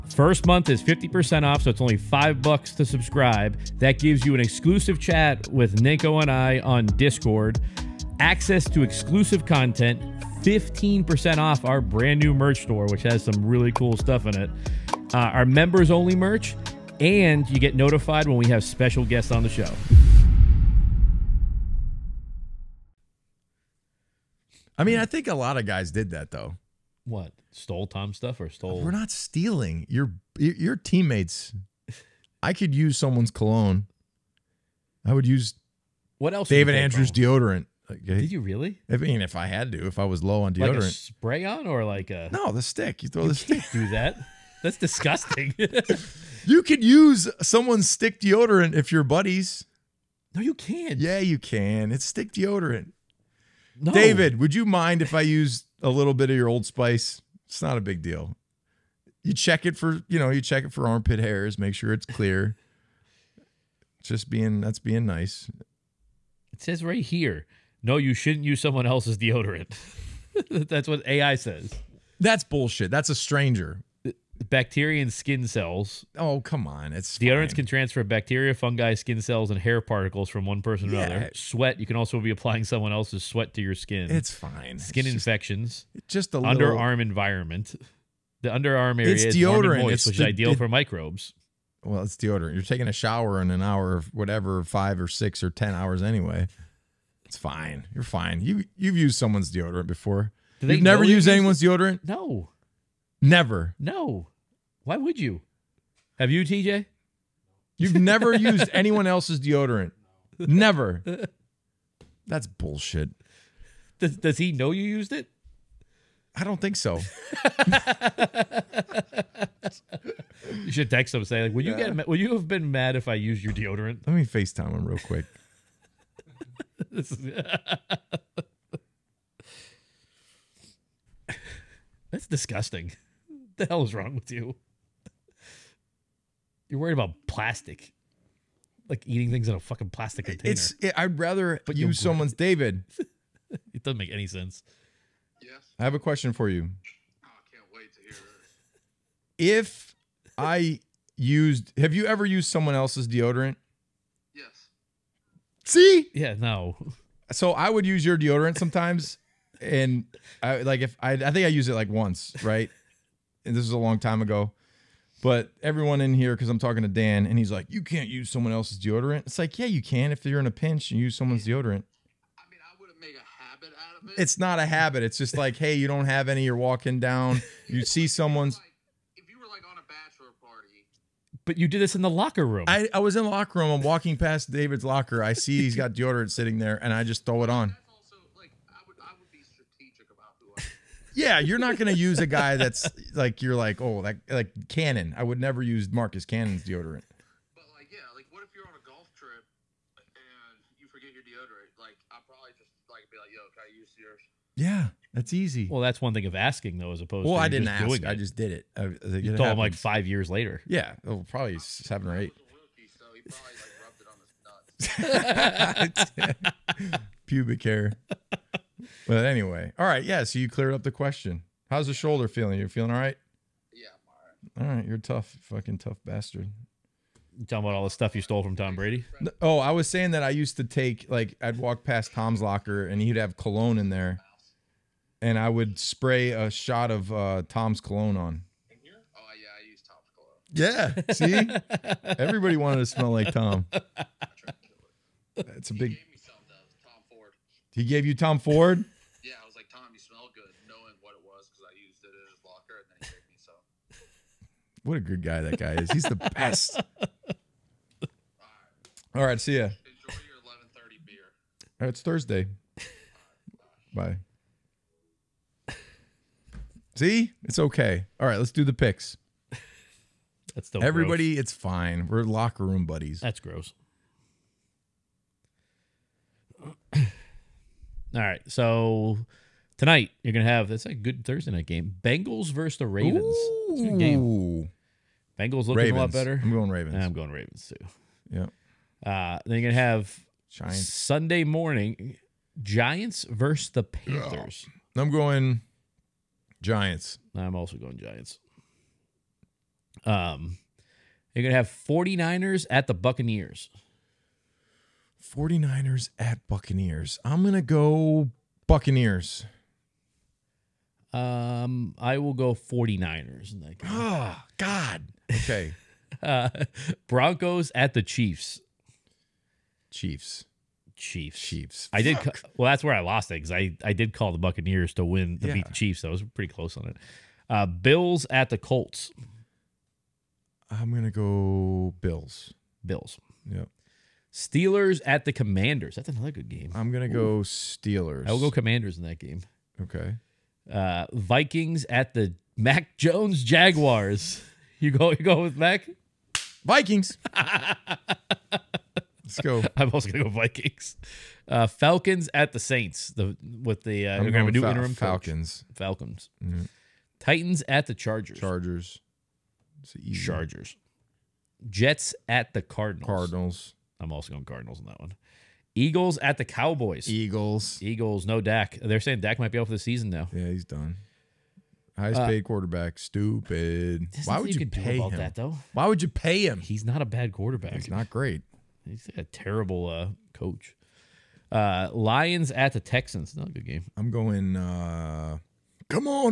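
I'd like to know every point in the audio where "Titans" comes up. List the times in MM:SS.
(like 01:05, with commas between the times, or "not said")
05:57.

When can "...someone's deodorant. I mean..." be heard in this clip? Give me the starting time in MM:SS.
02:51.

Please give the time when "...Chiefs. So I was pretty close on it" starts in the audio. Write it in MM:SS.
05:25.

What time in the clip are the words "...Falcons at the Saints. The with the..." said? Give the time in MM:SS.
05:51.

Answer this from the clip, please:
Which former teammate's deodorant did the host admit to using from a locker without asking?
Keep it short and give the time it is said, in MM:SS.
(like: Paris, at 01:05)
David Andrews, at 00:36.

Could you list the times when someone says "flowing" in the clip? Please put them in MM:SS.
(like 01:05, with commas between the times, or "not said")
not said.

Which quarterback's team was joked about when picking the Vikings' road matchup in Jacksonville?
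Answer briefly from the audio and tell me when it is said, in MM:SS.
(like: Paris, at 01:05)
Mac Jones, at 05:42.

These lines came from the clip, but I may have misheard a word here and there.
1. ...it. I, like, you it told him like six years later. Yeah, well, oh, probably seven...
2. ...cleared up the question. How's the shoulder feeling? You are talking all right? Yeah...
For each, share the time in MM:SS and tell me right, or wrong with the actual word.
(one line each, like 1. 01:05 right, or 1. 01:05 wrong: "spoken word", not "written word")
1. 03:28 wrong: "five", not "six"
2. 03:40 wrong: "feeling", not "talking".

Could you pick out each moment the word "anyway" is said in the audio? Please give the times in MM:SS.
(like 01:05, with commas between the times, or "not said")
01:36, 03:39.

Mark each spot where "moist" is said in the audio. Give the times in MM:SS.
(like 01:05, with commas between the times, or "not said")
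01:29.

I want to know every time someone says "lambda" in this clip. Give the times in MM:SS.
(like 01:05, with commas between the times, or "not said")
not said.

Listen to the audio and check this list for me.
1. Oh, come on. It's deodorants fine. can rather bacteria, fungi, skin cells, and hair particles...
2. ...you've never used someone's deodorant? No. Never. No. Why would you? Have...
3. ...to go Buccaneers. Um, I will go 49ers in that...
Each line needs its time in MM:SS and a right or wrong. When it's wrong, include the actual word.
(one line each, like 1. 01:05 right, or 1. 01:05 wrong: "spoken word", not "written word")
1. 01:16 wrong: "transfer", not "rather"
2. 01:40 wrong: "anyone", not "someone"
3. 05:07 right.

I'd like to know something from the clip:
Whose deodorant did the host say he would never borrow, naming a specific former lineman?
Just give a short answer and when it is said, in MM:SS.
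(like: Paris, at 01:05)
Marcus Cannon, at 03:15.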